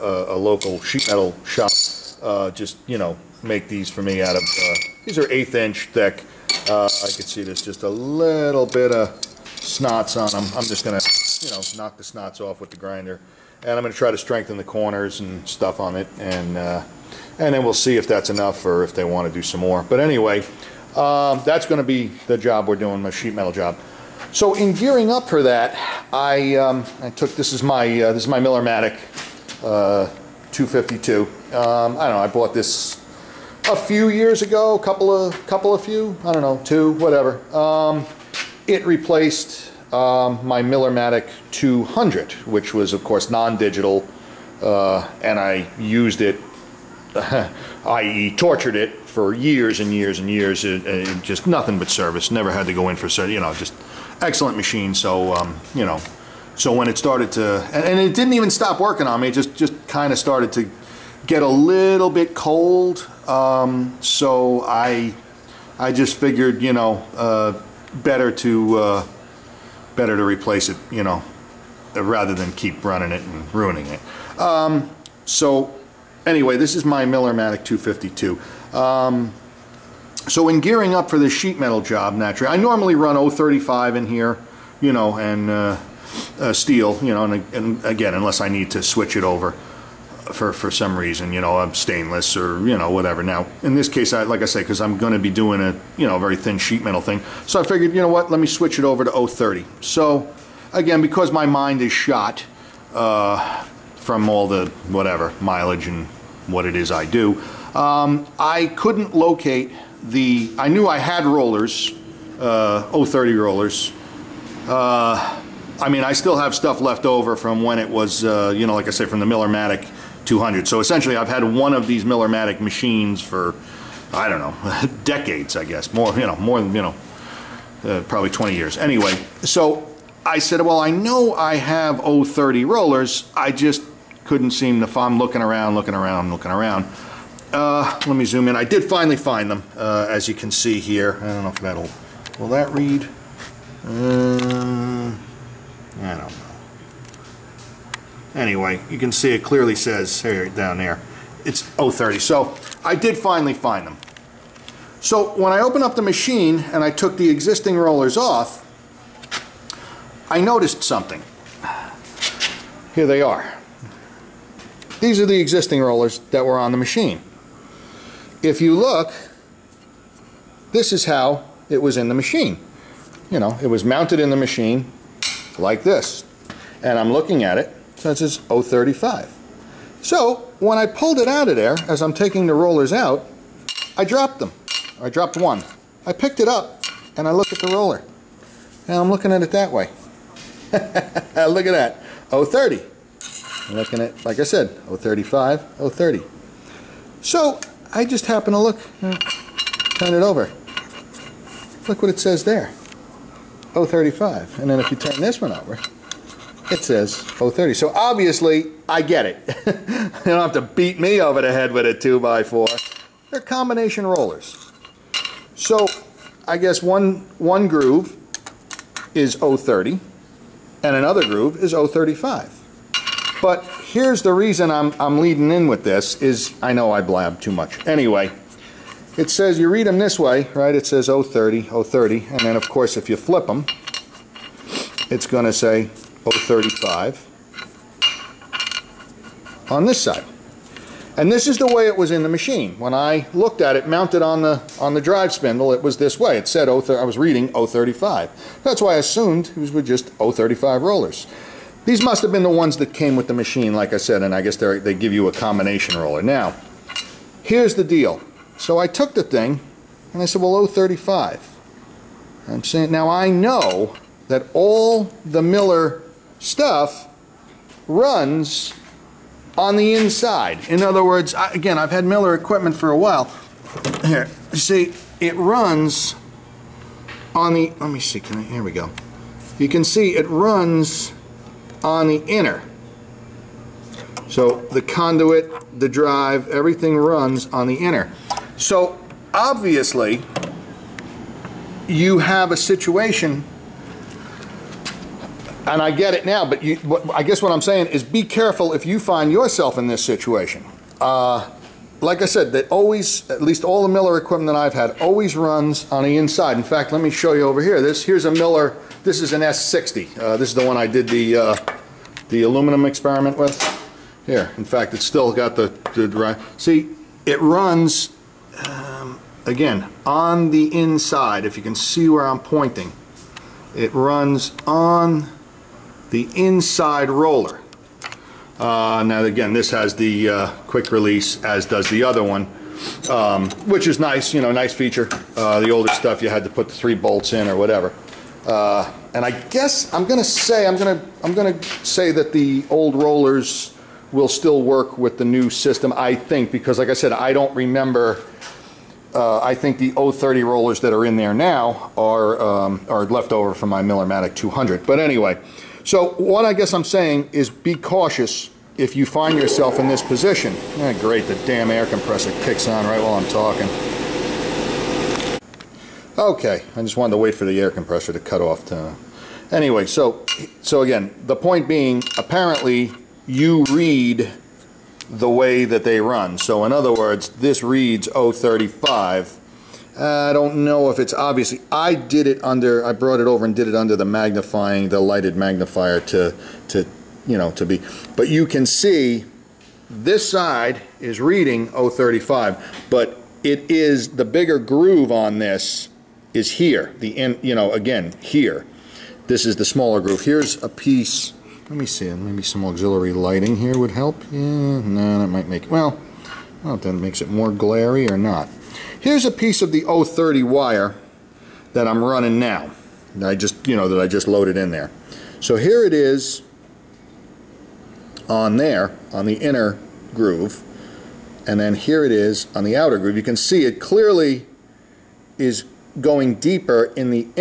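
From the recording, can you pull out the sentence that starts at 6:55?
So here it is on there, on the inner groove, and then here it is on the outer groove.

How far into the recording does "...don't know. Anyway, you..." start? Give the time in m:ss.
2:26.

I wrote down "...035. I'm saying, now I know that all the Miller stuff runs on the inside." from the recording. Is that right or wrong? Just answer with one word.
right.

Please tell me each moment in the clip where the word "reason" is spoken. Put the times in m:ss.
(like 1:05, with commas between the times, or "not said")
1:30, 3:44.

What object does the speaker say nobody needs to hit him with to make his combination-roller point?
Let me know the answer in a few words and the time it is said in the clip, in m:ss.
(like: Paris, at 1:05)
a 2x4, at 3:31.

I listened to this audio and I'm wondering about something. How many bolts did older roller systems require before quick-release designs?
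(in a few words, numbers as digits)
3.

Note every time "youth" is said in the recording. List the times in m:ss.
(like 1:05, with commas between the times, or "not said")
not said.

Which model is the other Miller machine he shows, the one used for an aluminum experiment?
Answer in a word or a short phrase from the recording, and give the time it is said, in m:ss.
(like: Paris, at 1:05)
S60, at 5:09.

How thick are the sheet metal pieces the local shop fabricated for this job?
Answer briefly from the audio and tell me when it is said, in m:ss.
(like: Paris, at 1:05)
1/8 inch, at 0:05.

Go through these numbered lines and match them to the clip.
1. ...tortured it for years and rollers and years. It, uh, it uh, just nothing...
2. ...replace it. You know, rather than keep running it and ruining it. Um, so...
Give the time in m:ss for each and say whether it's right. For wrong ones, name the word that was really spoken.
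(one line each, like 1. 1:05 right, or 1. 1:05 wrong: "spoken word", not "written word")
1. 0:48 wrong: "years", not "rollers"
2. 1:10 right.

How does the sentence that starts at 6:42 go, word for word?
Maybe some auxiliary lighting here would help.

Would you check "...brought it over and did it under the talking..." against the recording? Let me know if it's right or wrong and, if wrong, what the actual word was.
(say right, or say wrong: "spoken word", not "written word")
wrong: "magnifying", not "talking".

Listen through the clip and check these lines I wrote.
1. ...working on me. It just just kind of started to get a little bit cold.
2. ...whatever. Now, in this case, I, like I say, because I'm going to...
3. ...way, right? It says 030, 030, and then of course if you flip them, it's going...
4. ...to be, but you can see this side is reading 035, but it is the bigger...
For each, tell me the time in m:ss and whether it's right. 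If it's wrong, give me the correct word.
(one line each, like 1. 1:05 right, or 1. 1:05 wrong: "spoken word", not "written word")
1. 0:58 right
2. 1:32 right
3. 3:50 right
4. 6:27 right.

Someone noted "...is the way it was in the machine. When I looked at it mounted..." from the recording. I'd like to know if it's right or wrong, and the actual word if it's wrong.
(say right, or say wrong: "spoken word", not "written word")
right.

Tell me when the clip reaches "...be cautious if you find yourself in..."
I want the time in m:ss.
5:57.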